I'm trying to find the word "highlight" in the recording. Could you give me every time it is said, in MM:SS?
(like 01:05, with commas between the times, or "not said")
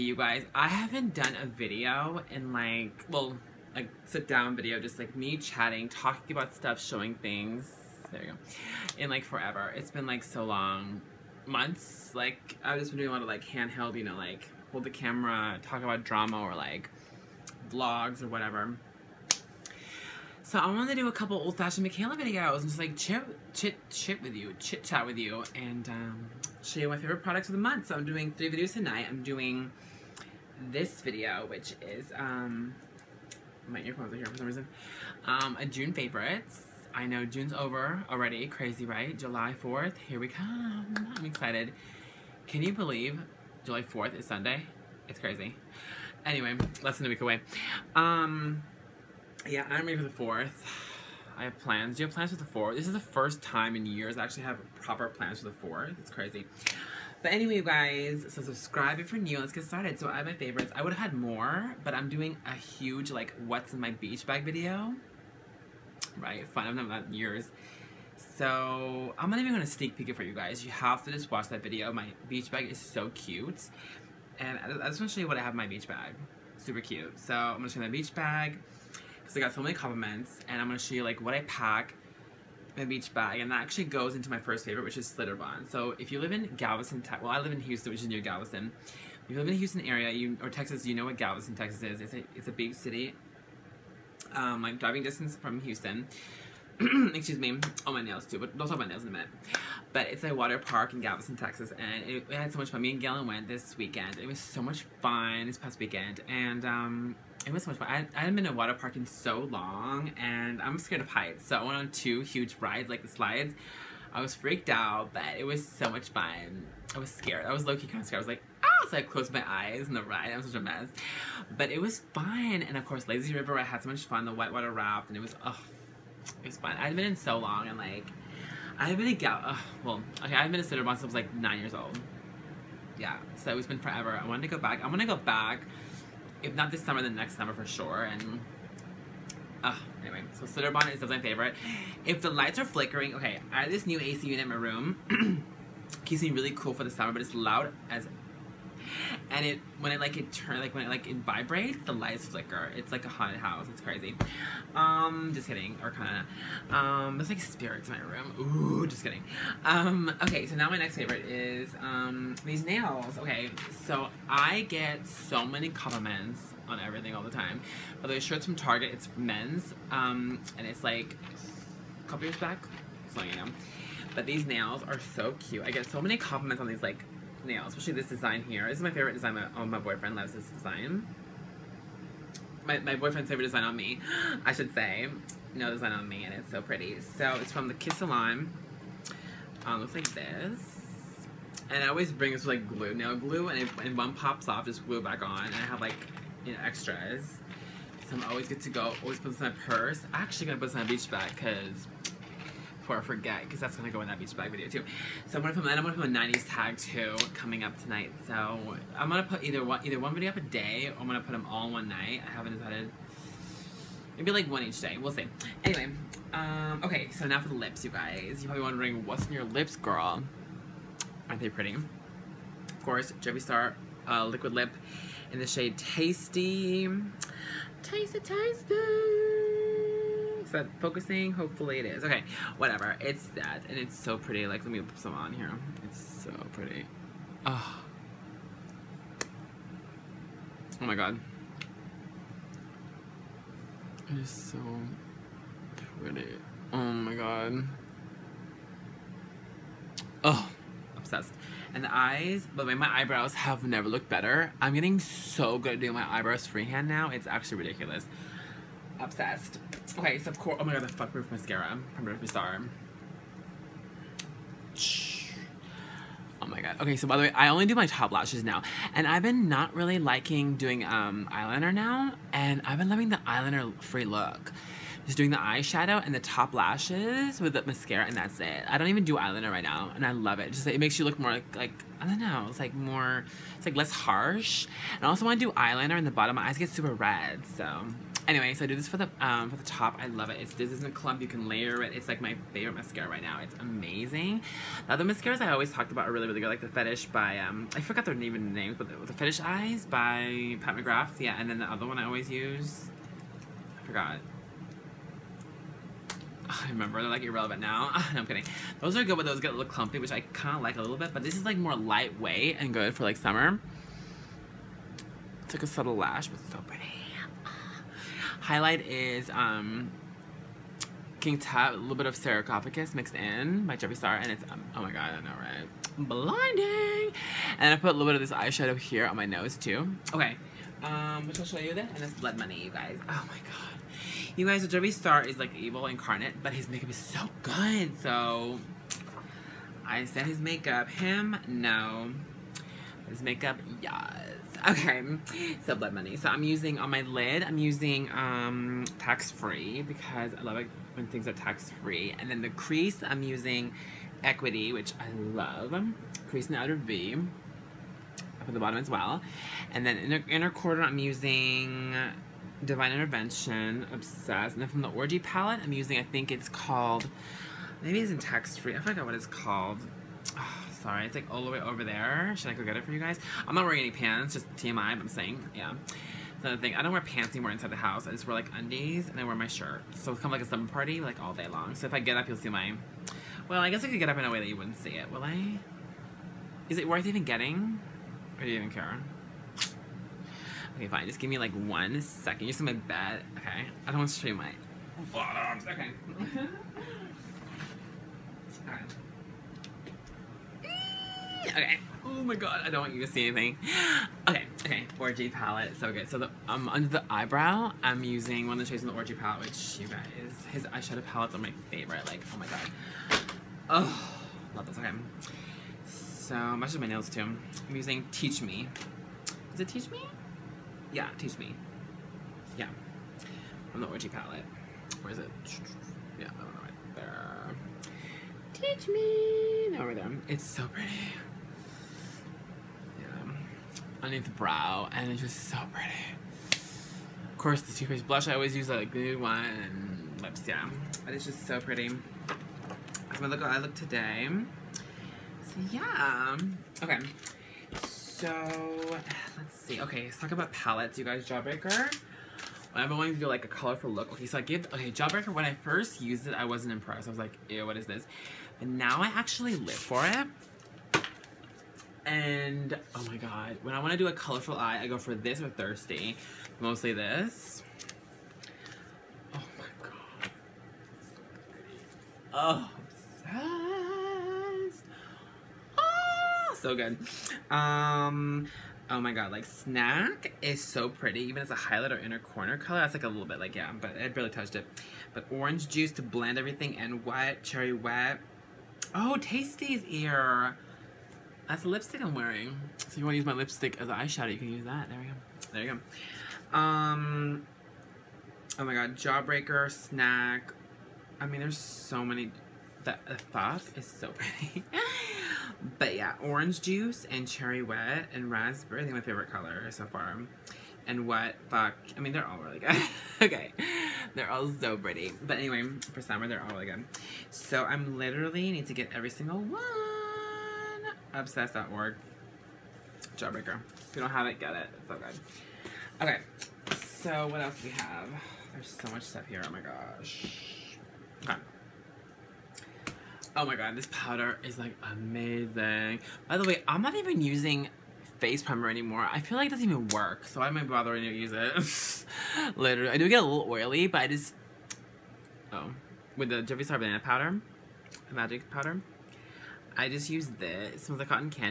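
05:18, 08:01.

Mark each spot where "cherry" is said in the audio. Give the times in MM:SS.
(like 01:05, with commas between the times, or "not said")
08:07, 08:27.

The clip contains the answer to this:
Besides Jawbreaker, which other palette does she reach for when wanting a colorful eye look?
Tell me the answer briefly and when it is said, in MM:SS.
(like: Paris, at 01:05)
Thirsty, at 07:45.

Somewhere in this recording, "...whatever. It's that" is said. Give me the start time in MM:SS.
03:52.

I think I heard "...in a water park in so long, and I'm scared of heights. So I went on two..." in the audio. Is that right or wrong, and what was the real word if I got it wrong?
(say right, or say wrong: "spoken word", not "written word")
right.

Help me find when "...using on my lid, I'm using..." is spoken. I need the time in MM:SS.
05:46.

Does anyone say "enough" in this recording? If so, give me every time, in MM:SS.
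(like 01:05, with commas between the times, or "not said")
not said.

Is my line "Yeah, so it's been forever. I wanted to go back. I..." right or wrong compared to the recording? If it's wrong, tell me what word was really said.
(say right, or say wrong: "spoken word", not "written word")
right.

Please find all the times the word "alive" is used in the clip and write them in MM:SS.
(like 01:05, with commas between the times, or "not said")
not said.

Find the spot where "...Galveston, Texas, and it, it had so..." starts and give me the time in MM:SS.
01:40.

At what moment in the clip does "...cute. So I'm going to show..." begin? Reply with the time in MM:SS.
01:16.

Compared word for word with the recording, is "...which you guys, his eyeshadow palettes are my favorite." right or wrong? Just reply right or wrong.
right.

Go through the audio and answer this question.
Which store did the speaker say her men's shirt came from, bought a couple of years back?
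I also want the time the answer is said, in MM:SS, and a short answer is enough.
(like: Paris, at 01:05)
Target, at 02:48.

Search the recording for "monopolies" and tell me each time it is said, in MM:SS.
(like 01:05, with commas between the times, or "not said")
not said.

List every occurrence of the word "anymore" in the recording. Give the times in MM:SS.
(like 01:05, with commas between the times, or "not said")
06:17, 08:58.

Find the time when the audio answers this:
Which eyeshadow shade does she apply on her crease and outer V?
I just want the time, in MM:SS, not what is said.
05:54.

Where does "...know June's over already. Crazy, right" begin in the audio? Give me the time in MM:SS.
00:37.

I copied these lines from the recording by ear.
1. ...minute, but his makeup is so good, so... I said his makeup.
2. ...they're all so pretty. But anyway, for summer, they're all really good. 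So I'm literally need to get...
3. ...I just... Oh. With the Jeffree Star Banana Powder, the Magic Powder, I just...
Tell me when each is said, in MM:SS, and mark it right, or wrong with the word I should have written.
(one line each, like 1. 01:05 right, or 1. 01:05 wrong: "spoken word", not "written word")
1. 05:35 wrong: "incarnate", not "minute"
2. 08:34 right
3. 09:04 right.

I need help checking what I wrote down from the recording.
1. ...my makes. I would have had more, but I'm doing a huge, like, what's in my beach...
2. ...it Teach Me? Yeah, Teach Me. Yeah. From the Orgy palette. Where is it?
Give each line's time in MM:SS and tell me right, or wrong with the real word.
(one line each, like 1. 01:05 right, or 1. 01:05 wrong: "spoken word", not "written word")
1. 01:00 wrong: "favorites", not "makes"
2. 06:59 right.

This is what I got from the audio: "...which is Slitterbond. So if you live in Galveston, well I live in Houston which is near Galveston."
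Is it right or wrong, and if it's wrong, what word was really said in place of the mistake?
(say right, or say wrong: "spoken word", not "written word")
right.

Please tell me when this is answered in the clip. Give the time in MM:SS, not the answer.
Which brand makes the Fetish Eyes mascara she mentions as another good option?
05:00.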